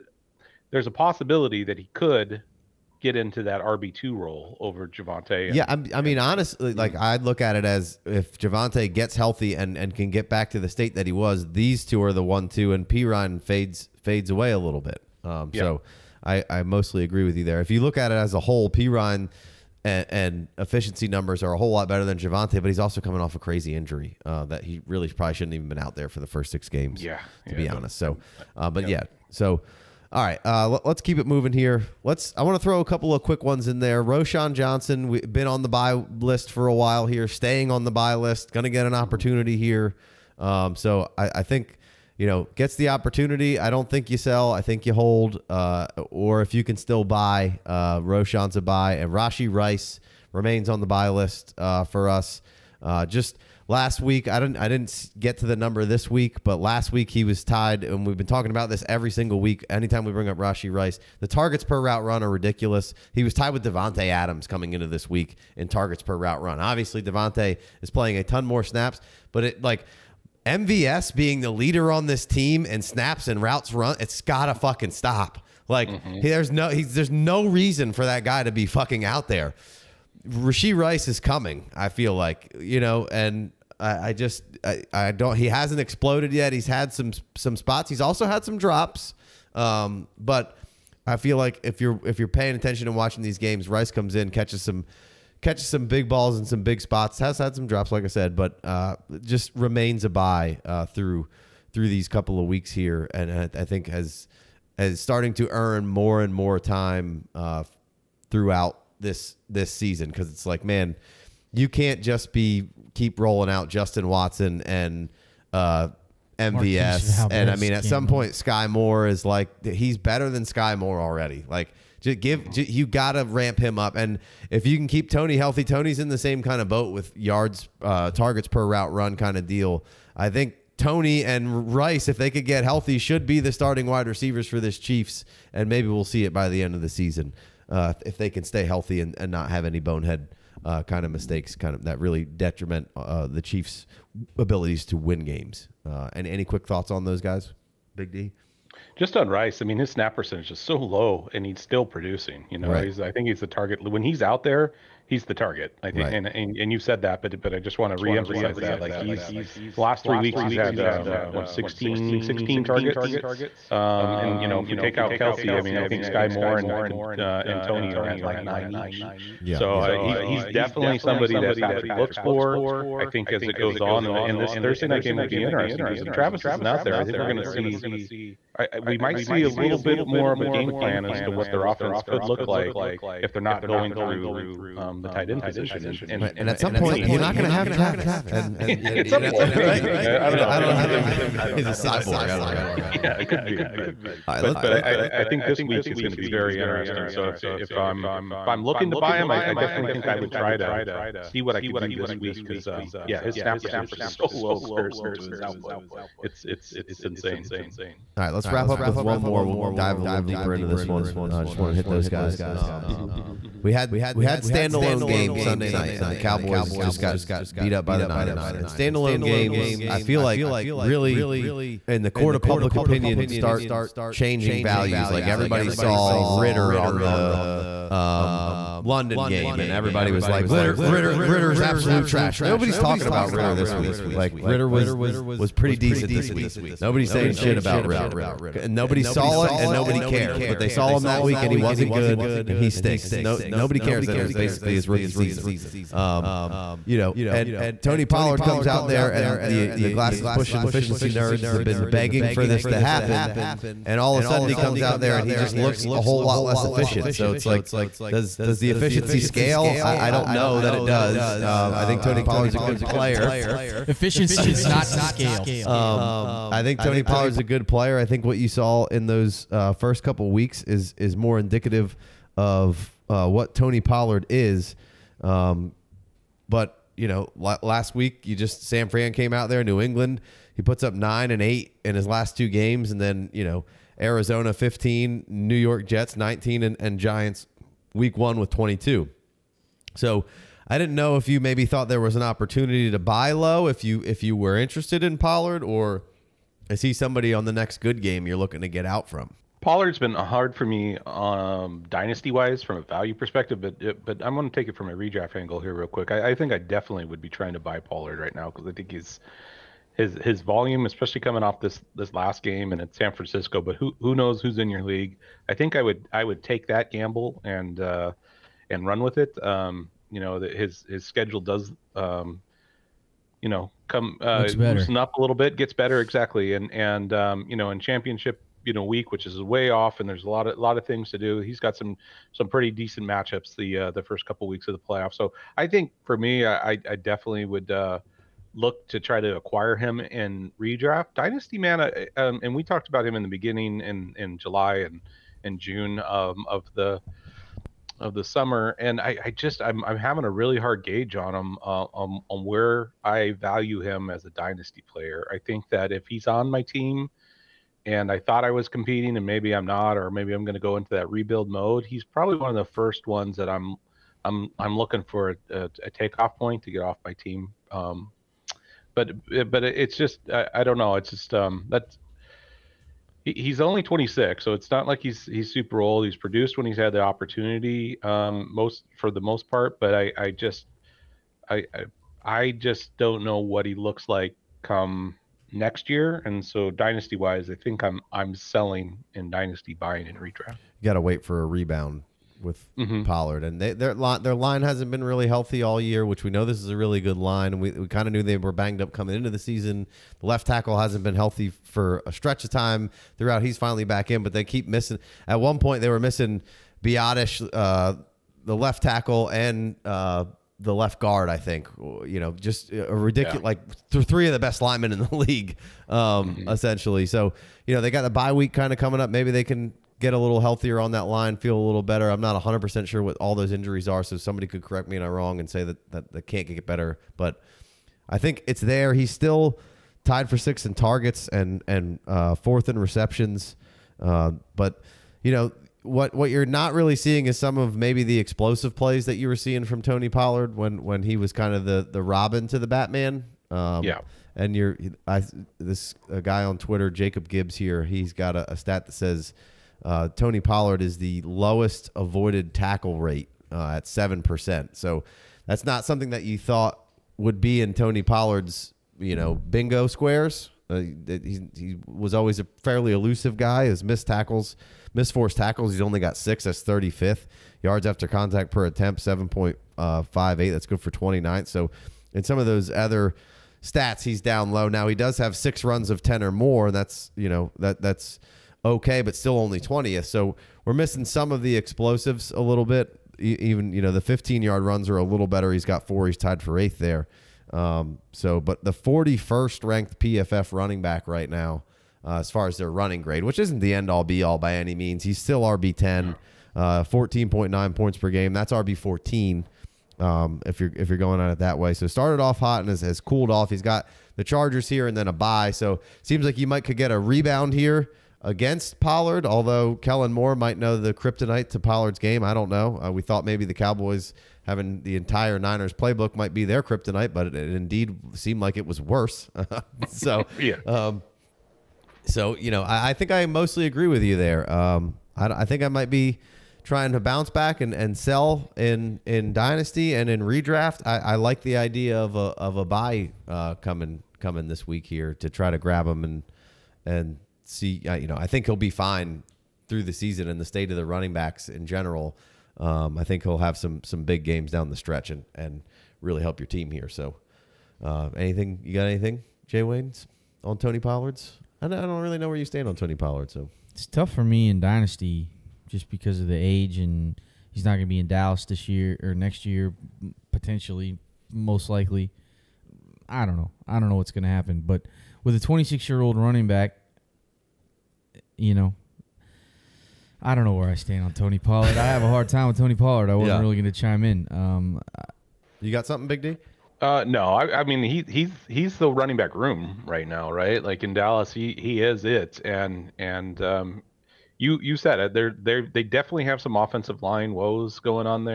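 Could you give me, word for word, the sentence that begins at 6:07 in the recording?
Um, but but it's just I, I don't know.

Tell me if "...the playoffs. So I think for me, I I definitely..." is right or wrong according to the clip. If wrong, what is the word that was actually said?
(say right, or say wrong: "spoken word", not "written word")
right.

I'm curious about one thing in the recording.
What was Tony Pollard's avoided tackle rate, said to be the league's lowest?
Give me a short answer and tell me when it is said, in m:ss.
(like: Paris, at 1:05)
7%, at 7:33.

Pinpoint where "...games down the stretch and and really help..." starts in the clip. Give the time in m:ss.
9:04.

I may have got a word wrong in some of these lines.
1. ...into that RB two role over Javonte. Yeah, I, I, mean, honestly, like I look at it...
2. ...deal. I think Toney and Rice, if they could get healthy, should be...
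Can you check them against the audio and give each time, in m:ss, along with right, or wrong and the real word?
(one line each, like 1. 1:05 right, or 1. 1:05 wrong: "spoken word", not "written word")
1. 0:03 right
2. 2:09 right.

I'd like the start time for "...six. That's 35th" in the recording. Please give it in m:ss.
7:46.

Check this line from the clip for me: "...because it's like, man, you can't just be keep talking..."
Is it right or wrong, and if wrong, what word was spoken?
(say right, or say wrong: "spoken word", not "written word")
wrong: "rolling", not "talking".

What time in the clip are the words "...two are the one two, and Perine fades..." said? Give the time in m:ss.
0:11.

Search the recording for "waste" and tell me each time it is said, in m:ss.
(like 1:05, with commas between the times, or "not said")
not said.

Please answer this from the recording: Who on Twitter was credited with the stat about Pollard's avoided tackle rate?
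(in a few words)
Jacob Gibbs.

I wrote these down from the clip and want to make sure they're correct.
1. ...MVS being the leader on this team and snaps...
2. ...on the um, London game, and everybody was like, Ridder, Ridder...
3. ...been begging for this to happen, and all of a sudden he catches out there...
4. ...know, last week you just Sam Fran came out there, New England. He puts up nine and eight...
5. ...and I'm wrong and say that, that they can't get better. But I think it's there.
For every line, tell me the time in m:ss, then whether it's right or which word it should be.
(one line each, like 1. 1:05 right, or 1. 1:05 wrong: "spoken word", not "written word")
1. 1:10 right
2. 3:46 right
3. 4:11 wrong: "comes", not "catches"
4. 4:37 right
5. 7:04 right.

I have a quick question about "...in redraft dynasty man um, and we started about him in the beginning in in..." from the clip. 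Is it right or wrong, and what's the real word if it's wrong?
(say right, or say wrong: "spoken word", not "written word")
wrong: "talked", not "started".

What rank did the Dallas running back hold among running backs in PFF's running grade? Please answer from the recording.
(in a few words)
41st.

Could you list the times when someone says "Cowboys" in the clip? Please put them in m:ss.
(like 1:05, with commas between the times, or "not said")
3:36, 8:33.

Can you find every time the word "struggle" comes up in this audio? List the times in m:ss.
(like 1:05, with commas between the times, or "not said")
not said.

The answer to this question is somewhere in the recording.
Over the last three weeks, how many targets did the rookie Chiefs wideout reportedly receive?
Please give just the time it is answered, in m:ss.
2:42.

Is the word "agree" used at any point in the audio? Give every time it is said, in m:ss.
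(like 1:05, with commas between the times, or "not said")
0:17, 8:43.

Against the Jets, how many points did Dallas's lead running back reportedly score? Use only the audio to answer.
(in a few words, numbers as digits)
19.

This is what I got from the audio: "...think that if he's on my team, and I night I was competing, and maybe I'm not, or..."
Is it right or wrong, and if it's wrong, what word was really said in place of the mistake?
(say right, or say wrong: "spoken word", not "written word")
wrong: "thought", not "night".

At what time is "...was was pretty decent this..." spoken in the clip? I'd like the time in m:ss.
3:54.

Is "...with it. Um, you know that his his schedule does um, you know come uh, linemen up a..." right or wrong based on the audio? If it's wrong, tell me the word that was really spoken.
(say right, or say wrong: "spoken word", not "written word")
wrong: "loosen", not "linemen".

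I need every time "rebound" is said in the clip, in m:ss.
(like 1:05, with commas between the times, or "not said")
6:31, 8:26.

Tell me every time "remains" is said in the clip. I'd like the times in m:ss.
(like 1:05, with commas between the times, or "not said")
0:50, 1:39.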